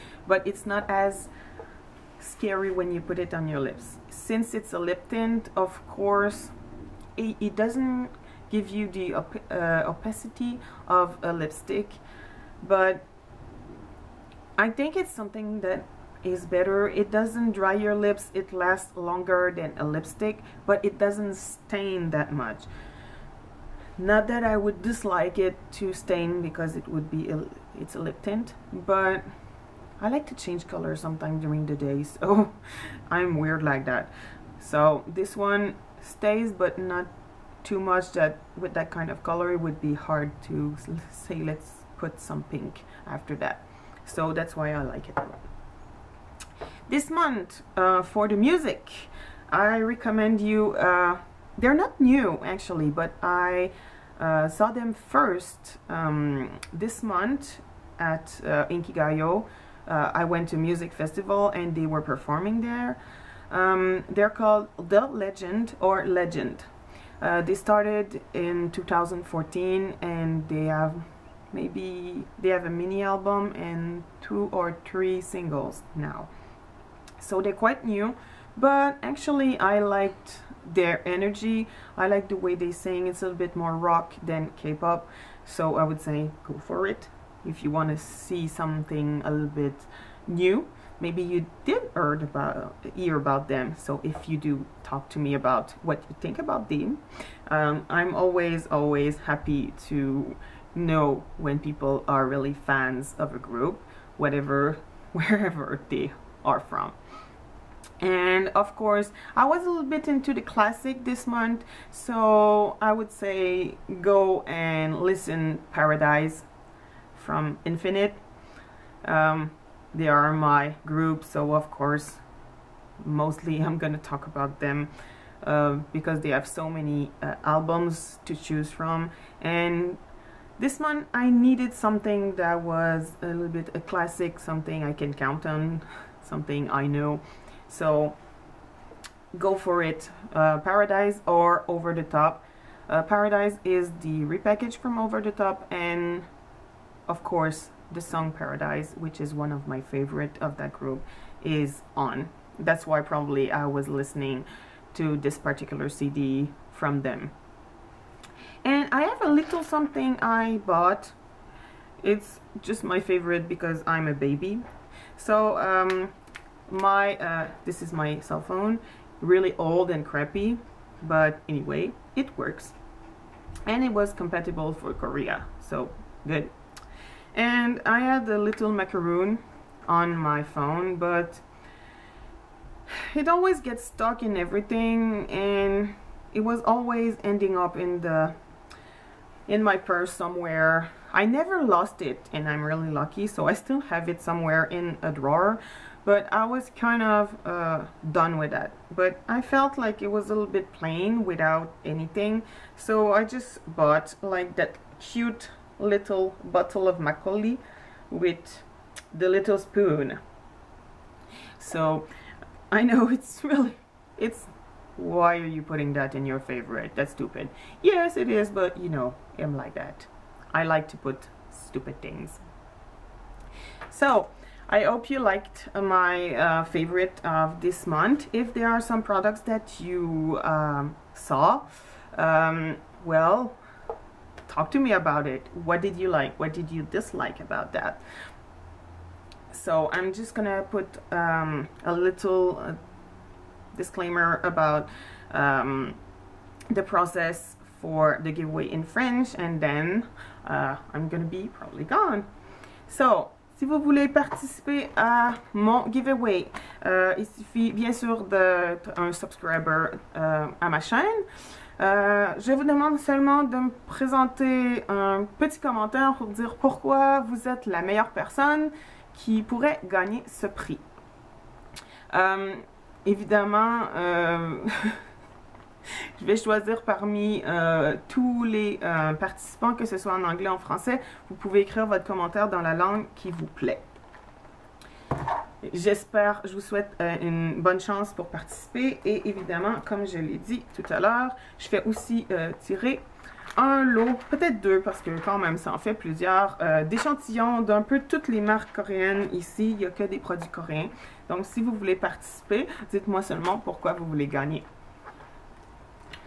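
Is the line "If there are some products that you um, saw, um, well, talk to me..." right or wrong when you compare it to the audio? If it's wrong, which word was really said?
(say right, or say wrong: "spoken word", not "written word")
right.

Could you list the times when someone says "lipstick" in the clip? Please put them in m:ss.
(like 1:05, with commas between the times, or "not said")
0:11, 0:19.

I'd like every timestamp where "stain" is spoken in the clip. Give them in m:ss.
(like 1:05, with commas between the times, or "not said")
0:21, 0:25.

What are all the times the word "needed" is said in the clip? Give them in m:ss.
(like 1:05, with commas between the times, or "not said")
2:11.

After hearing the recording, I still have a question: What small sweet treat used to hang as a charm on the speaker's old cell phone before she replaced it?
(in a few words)
macaroon.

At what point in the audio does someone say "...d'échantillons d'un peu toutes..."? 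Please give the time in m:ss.
4:56.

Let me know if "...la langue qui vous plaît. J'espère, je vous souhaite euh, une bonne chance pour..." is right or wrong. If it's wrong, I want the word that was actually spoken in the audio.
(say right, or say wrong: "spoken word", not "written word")
right.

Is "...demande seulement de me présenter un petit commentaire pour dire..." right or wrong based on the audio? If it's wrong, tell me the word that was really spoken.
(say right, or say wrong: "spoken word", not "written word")
right.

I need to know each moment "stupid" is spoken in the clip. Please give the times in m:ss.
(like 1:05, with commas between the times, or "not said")
3:37, 3:41.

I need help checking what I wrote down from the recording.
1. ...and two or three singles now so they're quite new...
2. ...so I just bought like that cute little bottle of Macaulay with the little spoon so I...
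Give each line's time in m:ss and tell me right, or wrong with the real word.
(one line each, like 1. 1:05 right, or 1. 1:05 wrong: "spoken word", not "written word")
1. 1:13 right
2. 3:22 right.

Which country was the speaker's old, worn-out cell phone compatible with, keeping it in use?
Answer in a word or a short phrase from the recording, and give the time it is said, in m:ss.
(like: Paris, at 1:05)
Korea, at 2:54.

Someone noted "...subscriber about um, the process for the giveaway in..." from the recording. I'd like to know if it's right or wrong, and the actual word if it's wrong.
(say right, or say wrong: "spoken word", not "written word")
wrong: "disclaimer", not "subscriber".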